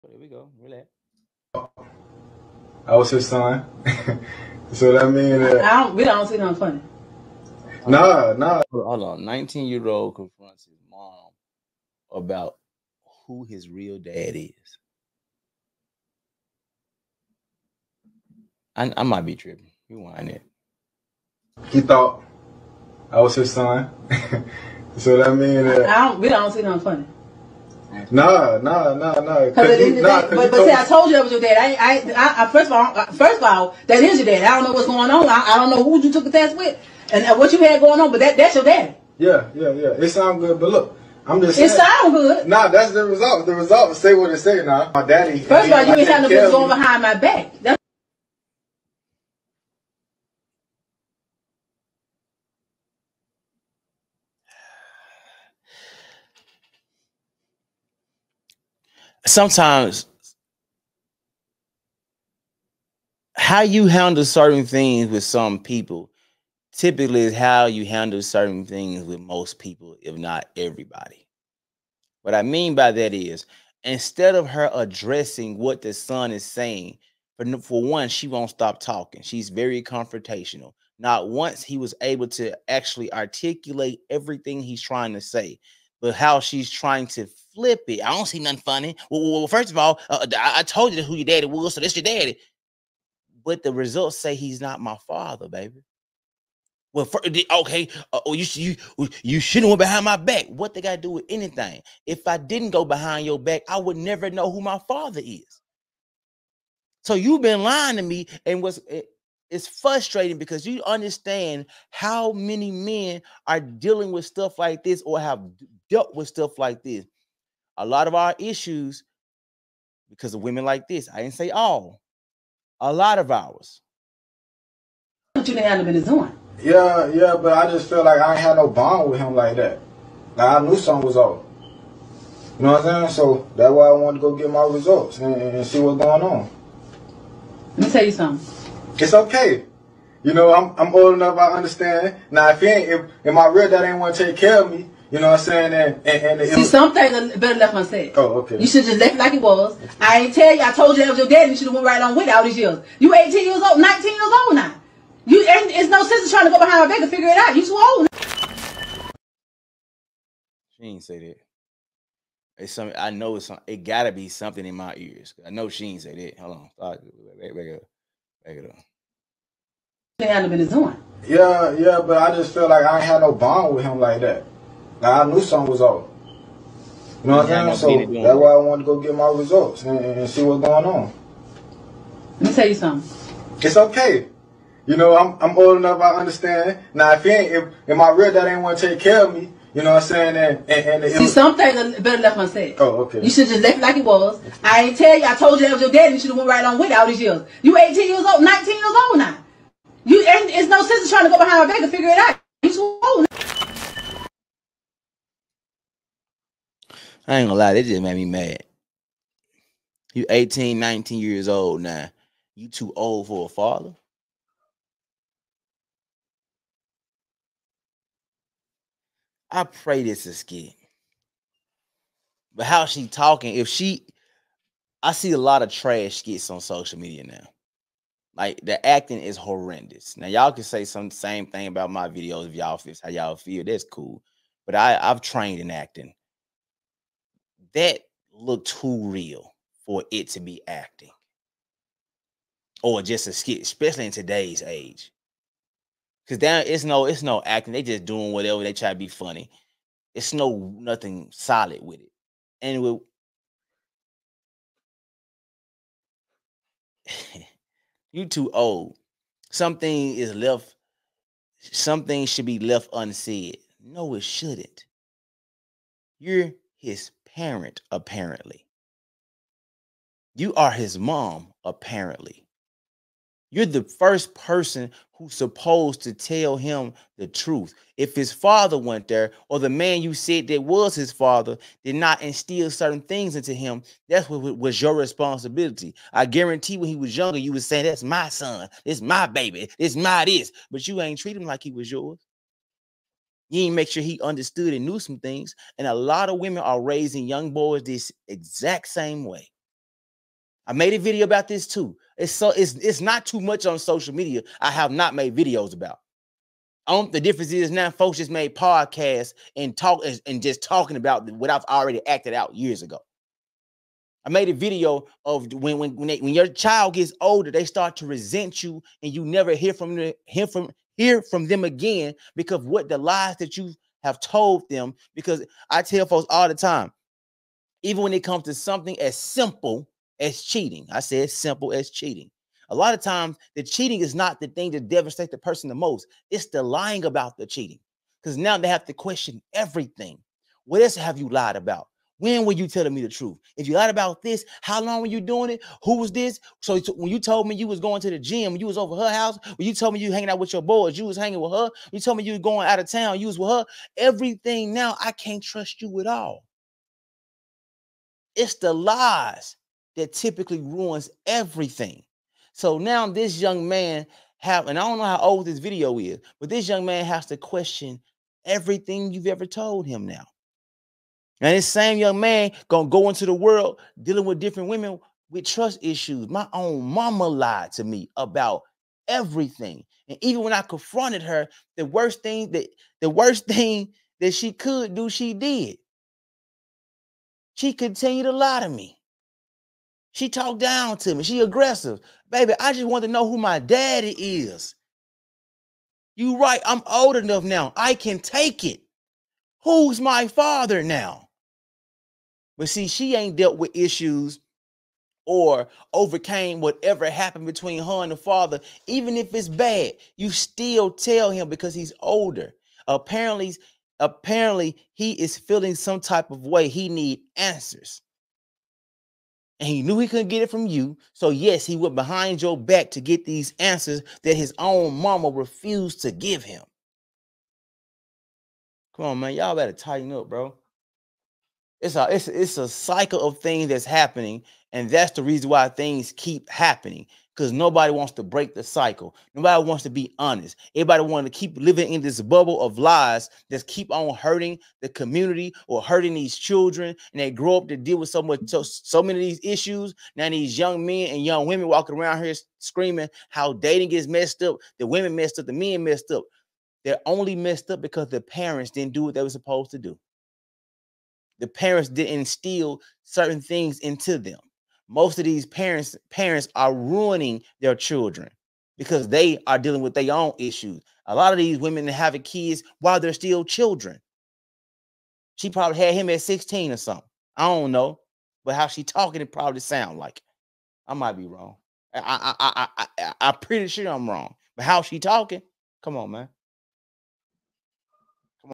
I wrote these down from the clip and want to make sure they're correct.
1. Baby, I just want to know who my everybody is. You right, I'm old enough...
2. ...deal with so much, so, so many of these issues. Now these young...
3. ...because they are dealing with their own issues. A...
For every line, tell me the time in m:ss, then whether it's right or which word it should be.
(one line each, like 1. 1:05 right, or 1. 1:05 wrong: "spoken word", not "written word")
1. 6:32 wrong: "daddy", not "everybody"
2. 7:27 right
3. 7:48 right.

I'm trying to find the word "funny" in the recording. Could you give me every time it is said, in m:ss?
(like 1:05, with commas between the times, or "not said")
0:06, 0:26, 1:28, 4:09.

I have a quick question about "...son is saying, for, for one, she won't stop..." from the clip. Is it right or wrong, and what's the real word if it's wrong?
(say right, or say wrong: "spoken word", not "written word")
right.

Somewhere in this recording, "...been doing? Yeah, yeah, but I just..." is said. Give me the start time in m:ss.
2:05.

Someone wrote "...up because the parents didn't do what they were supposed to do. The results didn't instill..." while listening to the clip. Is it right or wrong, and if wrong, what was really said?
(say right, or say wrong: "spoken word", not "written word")
wrong: "parents", not "results".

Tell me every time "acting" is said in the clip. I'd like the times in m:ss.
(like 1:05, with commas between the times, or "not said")
3:48, 3:55, 4:00, 4:07.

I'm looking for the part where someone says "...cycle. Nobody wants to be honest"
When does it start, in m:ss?
7:18.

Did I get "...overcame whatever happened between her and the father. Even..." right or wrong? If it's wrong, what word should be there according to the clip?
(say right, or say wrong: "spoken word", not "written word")
right.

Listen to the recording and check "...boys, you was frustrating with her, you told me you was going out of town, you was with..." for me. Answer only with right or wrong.
wrong.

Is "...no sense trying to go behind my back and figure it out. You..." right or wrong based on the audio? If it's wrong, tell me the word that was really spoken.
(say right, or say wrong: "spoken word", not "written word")
right.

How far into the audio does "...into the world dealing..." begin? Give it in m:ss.
6:13.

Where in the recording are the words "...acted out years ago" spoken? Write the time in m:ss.
5:12.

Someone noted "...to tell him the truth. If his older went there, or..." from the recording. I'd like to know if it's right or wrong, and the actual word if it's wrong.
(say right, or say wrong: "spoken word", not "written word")
wrong: "father", not "older".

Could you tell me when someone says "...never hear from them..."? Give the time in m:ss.
5:19.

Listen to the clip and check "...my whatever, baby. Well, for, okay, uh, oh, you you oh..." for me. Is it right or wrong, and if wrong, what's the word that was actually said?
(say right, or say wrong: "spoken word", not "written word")
wrong: "father", not "whatever".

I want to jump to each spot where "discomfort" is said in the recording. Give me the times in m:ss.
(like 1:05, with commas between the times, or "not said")
not said.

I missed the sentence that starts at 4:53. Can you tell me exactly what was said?
You ain't make sure he understood and knew some things.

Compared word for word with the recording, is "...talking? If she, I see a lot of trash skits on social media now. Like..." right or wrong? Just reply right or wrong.
right.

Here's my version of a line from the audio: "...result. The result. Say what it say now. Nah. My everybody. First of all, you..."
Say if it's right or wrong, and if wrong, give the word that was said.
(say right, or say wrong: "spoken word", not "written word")
wrong: "daddy", not "everybody".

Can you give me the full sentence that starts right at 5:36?
It's the lying about the cheating, because now they have to question everything.